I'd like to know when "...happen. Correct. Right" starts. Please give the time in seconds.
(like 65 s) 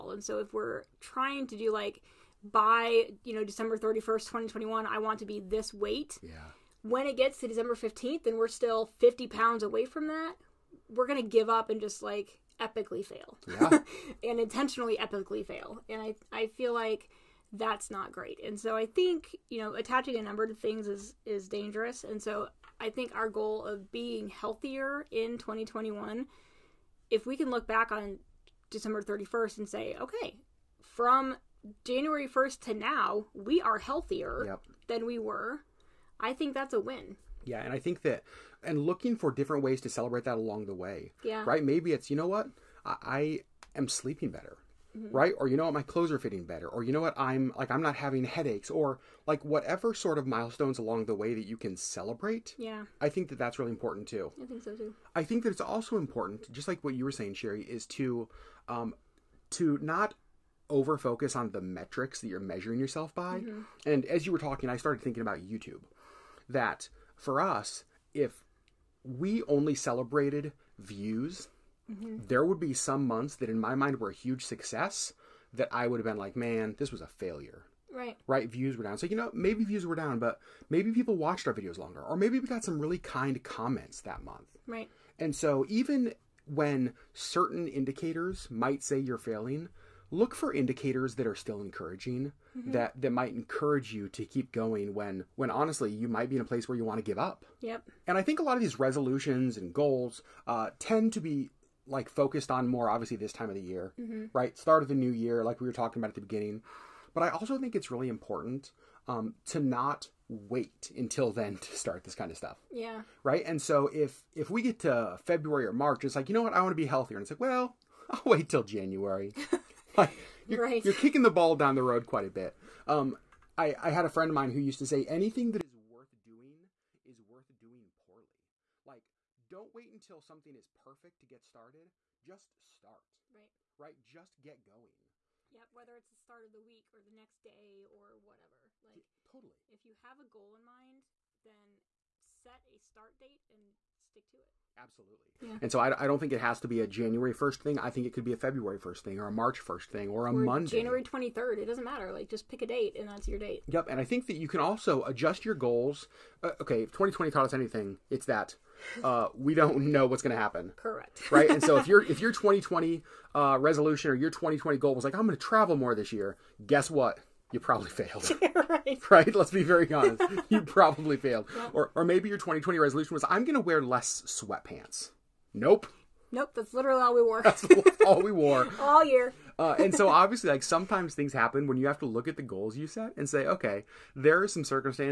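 160 s.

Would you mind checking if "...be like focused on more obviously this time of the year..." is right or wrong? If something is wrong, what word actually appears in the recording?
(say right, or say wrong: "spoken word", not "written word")
right.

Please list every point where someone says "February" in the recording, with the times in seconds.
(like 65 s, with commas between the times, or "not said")
115 s, 148 s.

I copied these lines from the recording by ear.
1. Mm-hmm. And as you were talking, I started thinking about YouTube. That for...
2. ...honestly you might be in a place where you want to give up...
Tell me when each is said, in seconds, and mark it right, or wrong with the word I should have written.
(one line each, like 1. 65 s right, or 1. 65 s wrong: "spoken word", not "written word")
1. 63 s right
2. 95 s right.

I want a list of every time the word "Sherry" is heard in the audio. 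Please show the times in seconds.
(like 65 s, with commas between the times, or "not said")
57 s.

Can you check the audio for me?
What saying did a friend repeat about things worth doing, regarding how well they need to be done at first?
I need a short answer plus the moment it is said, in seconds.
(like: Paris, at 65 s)
Worth doing poorly, at 127 s.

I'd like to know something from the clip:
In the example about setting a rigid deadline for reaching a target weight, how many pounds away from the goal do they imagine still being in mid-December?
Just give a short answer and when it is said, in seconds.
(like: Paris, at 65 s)
50, at 8 s.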